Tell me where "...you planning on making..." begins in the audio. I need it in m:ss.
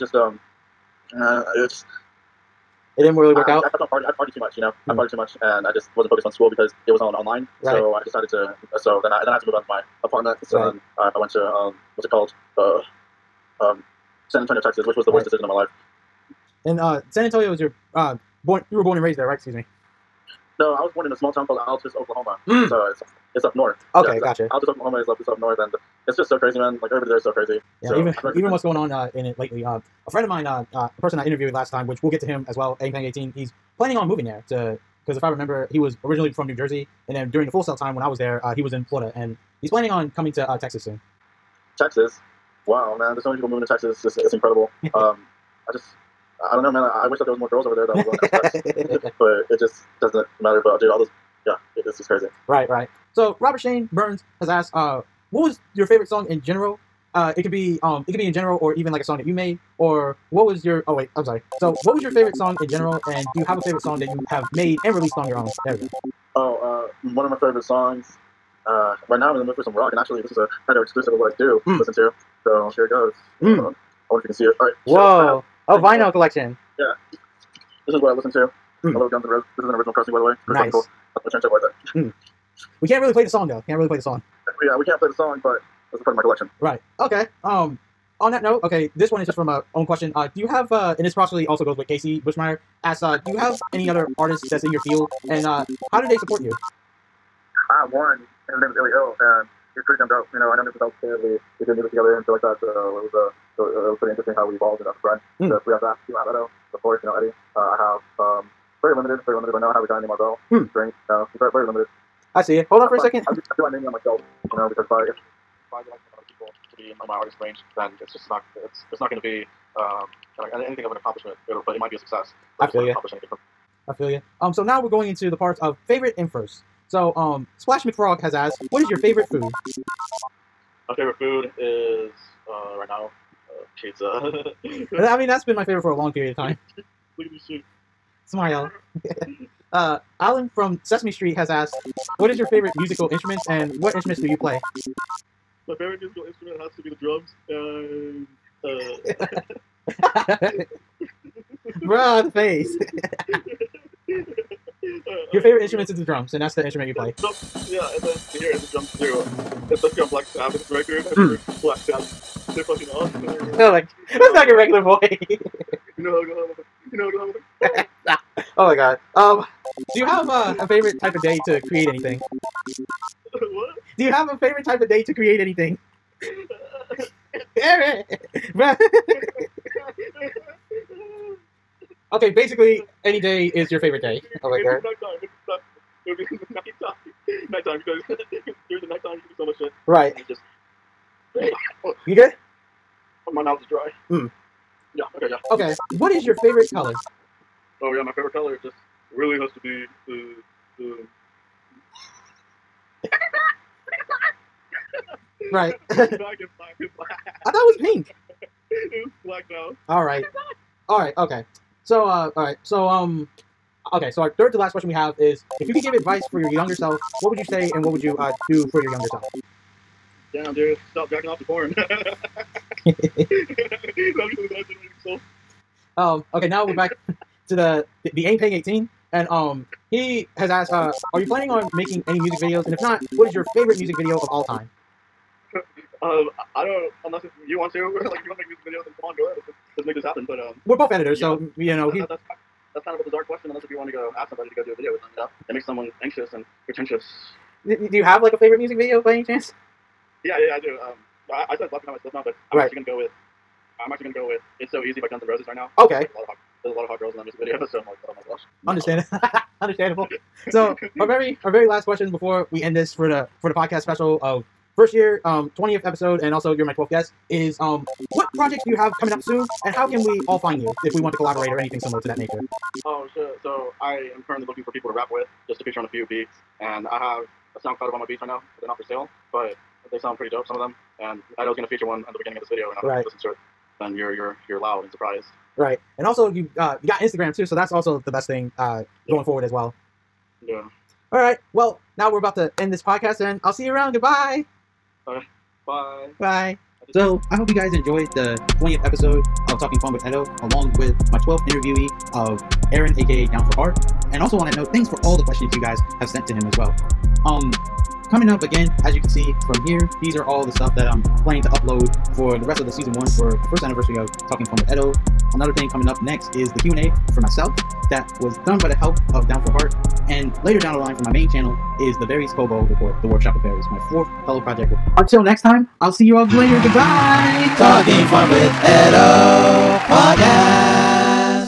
3:51.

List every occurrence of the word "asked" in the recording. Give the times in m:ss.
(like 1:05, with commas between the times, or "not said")
0:54, 2:08, 2:21, 3:50.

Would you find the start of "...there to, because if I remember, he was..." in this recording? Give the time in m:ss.
0:34.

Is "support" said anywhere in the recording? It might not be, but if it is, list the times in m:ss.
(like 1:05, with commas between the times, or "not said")
1:36.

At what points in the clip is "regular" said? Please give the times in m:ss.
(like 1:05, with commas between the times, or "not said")
2:44.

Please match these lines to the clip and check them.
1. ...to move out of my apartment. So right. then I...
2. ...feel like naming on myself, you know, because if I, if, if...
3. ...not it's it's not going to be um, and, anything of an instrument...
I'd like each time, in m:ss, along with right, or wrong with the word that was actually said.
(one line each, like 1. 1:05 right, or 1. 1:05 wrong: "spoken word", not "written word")
1. 0:09 right
2. 1:53 right
3. 1:58 wrong: "accomplishment", not "instrument".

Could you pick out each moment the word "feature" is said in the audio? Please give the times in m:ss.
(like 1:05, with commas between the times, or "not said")
4:35, 4:41.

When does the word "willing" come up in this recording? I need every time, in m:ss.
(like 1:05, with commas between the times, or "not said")
0:48.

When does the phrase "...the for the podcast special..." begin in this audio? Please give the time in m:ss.
4:23.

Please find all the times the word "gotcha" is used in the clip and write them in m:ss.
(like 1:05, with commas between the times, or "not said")
0:24.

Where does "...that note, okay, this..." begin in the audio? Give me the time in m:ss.
1:28.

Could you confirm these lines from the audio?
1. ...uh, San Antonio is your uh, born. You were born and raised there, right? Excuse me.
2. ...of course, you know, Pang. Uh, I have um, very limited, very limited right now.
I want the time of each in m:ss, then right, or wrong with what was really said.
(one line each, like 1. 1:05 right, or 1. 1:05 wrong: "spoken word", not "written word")
1. 0:16 right
2. 1:46 wrong: "Eddie", not "Pang".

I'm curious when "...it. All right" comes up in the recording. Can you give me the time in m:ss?
1:14.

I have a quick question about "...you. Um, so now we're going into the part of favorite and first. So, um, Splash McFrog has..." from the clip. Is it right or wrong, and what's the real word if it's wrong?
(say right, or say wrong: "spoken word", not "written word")
right.